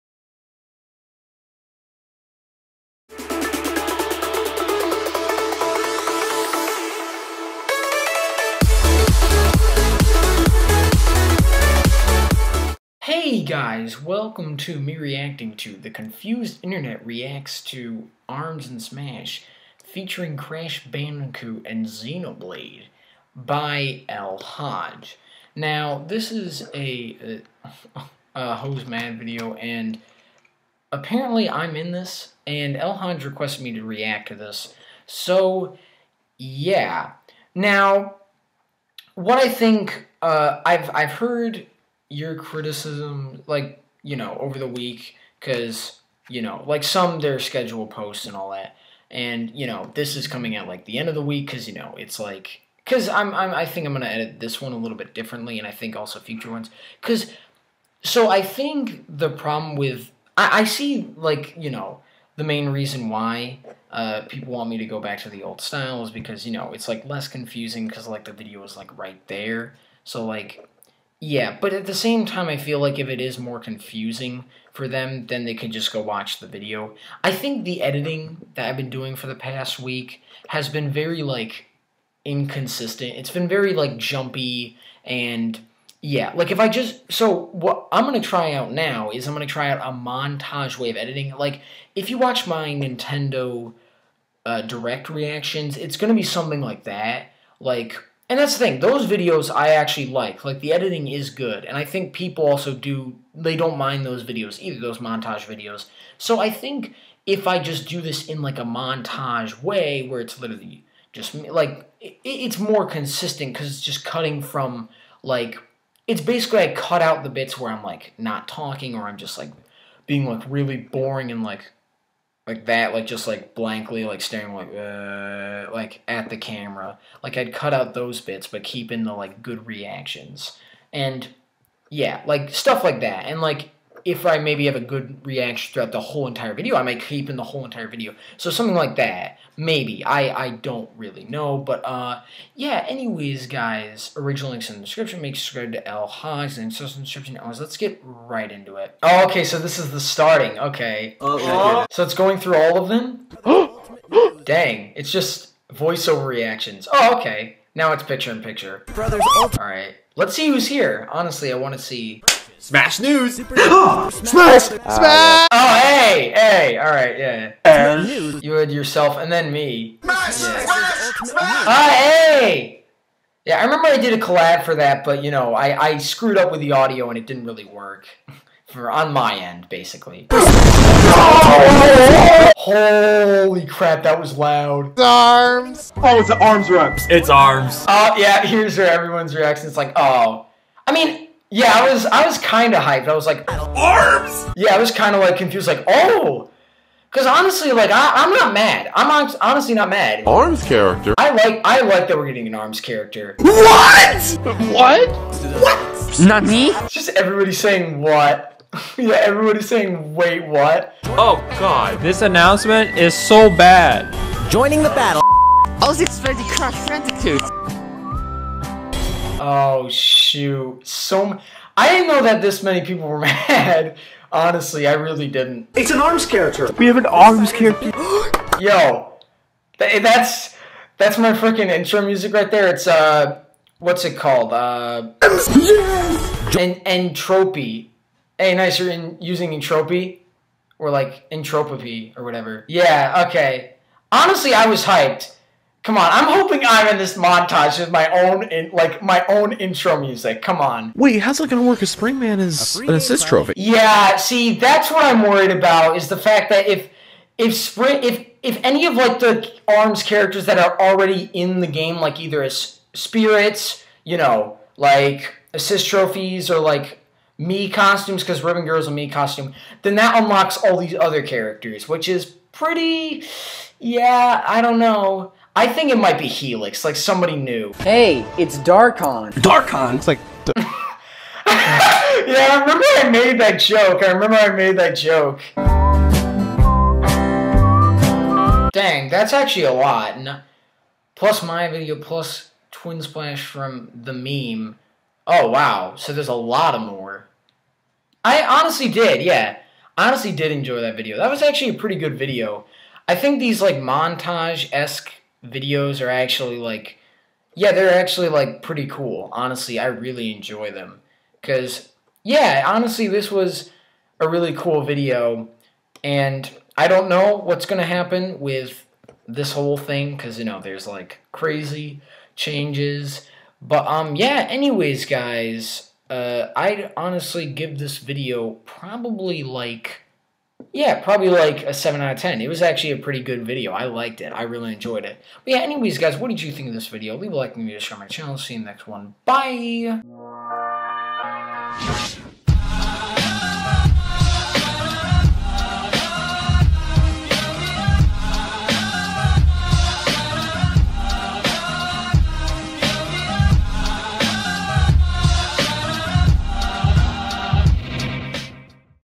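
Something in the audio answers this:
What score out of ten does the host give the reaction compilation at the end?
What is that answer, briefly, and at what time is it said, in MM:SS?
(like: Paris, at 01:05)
7, at 05:31.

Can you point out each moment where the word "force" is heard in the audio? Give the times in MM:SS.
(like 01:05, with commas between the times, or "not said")
not said.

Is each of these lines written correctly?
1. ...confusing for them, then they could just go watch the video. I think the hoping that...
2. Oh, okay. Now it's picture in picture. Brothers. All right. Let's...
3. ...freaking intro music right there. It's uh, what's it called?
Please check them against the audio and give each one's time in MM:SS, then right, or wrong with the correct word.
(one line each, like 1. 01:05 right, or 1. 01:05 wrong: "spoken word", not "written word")
1. 01:13 wrong: "editing", not "hoping"
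2. 02:36 right
3. 03:51 right.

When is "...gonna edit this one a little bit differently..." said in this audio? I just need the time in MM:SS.
00:53.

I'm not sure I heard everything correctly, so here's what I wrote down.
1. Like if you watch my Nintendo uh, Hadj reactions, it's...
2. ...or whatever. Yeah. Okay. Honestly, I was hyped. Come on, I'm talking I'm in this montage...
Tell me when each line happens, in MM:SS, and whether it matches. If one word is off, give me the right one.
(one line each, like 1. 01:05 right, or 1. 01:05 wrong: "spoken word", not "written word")
1. 01:31 wrong: "Direct", not "Hadj"
2. 04:02 wrong: "hoping", not "talking".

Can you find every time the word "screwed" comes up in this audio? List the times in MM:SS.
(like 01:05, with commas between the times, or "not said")
02:55.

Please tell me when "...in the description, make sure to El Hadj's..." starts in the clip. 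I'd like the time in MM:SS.
02:24.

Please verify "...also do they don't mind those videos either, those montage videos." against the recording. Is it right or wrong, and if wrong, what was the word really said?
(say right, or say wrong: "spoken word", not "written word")
right.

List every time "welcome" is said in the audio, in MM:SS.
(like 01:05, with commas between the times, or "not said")
00:14.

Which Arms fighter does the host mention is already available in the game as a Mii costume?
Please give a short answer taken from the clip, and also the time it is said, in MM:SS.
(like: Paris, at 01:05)
Ribbon Girl, at 04:28.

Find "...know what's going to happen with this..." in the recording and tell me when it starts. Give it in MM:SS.
05:17.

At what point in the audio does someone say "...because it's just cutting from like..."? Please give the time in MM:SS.
01:53.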